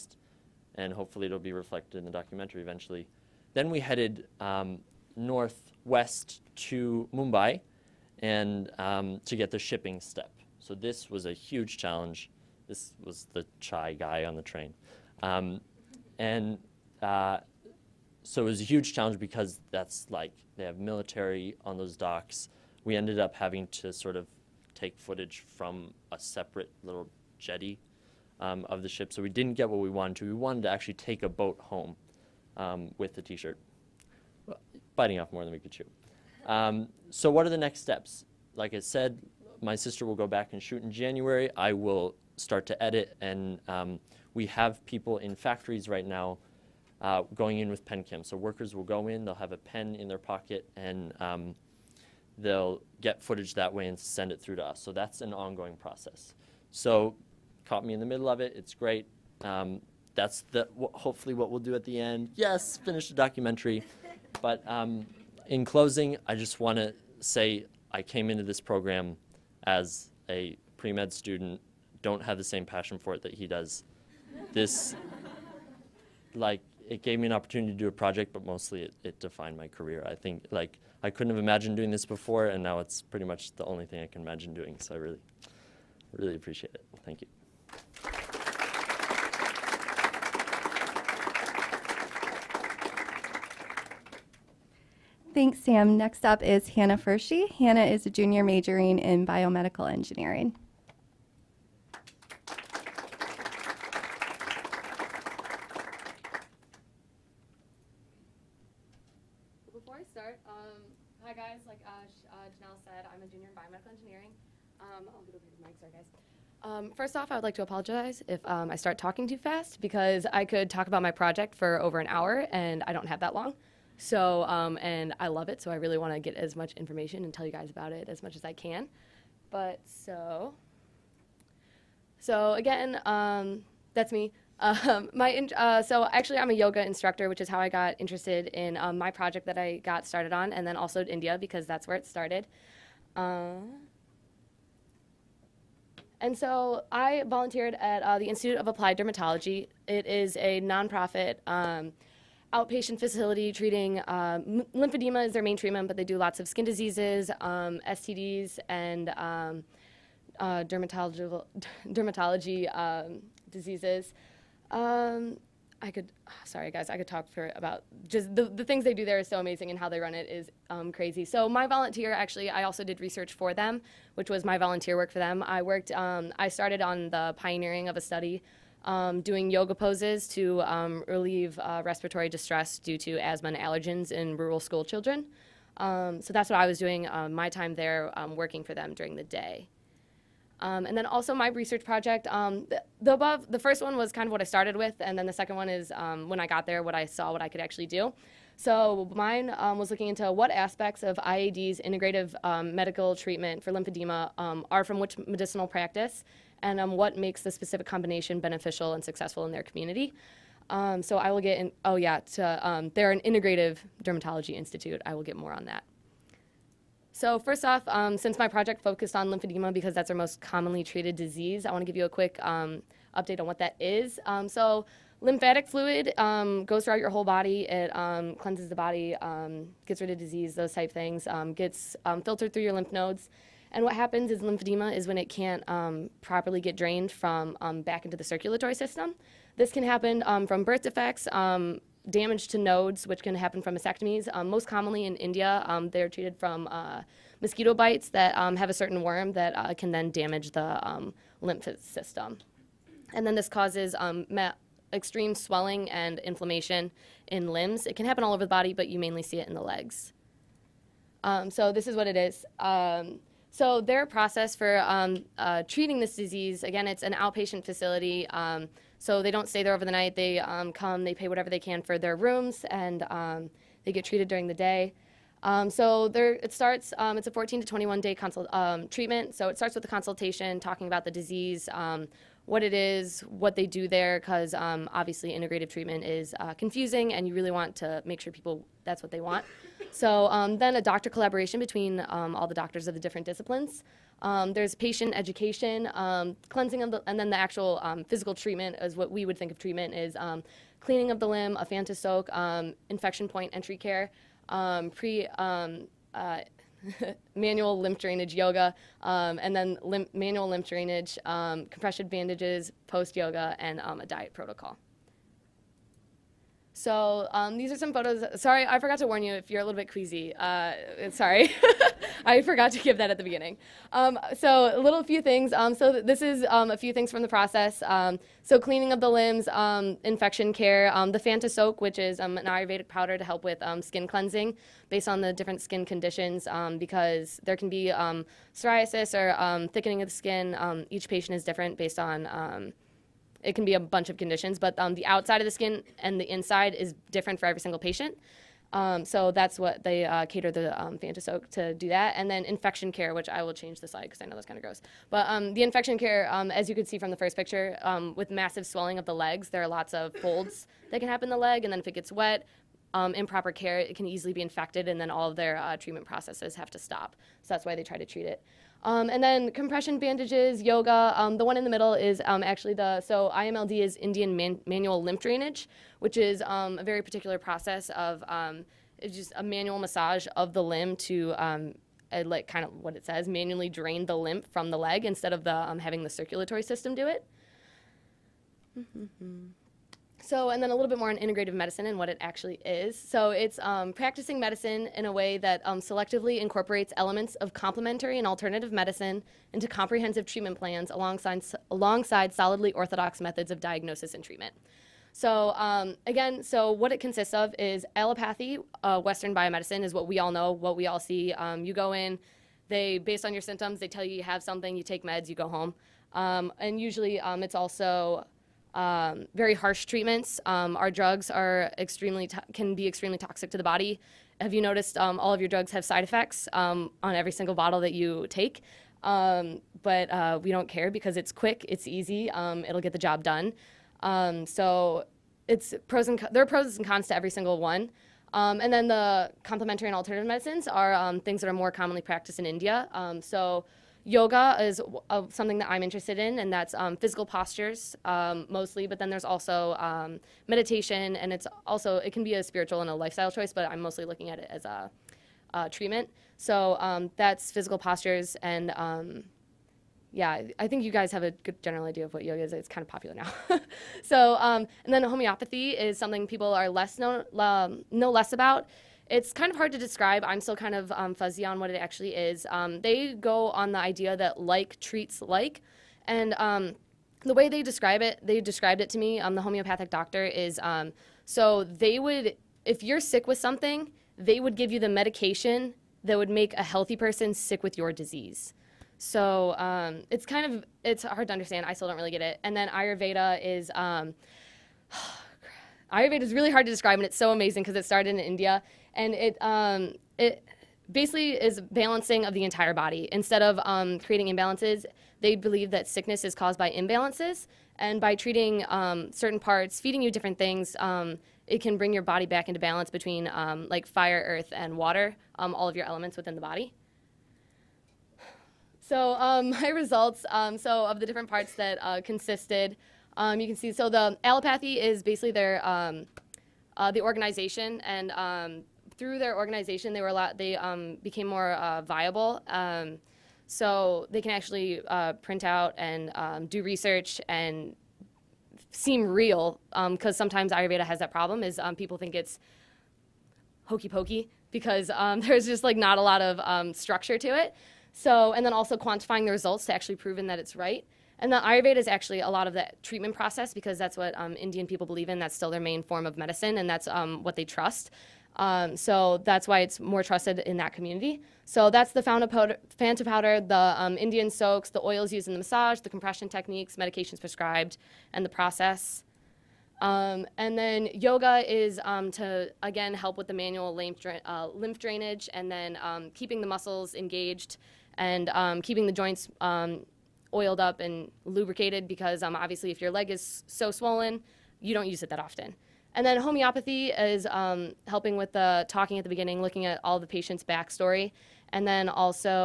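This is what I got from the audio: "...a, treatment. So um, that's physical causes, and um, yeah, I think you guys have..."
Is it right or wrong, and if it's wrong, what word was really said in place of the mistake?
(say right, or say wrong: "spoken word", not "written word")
wrong: "postures", not "causes".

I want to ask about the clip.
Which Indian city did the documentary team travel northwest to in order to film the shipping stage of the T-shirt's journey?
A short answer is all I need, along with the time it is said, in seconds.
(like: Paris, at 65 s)
Mumbai, at 7 s.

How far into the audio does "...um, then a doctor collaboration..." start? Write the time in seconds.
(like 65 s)
290 s.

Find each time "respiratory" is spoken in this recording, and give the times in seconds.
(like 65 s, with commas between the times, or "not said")
181 s.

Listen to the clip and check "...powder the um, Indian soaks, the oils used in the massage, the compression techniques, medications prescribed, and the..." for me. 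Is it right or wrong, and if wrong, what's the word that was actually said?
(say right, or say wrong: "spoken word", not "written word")
right.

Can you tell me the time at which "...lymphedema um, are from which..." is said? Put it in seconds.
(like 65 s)
203 s.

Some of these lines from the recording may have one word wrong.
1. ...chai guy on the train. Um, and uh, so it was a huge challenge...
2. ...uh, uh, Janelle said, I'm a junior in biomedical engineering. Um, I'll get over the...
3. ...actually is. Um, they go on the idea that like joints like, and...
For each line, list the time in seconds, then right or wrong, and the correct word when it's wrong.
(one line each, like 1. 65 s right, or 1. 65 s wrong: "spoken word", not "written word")
1. 13 s right
2. 111 s right
3. 471 s wrong: "treats", not "joints".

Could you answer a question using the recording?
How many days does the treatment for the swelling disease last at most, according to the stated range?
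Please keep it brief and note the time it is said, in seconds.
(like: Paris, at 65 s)
21, at 277 s.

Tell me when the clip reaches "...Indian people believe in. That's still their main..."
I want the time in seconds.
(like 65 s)
554 s.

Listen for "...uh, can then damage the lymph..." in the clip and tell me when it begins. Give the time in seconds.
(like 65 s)
249 s.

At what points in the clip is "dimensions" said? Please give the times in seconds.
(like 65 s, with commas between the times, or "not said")
not said.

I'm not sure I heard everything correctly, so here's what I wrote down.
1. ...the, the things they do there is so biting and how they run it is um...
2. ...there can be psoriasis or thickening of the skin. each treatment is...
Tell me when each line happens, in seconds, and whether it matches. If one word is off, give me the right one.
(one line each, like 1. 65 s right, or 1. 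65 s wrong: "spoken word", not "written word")
1. 168 s wrong: "amazing", not "biting"
2. 337 s wrong: "patient", not "treatment".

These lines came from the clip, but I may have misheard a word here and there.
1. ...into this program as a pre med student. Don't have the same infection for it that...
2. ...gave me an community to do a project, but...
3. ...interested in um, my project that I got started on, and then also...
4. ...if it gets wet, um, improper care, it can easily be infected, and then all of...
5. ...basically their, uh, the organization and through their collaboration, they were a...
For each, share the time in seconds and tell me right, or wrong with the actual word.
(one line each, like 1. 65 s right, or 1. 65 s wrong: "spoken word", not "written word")
1. 68 s wrong: "passion", not "infection"
2. 77 s wrong: "opportunity", not "community"
3. 137 s right
4. 361 s right
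5. 525 s wrong: "organization", not "collaboration".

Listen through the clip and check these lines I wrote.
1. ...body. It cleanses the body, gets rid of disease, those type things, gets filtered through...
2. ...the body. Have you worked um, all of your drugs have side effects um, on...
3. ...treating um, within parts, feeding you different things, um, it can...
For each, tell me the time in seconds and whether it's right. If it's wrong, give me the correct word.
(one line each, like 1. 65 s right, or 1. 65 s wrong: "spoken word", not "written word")
1. 227 s right
2. 423 s wrong: "noticed", not "worked"
3. 508 s wrong: "certain", not "within".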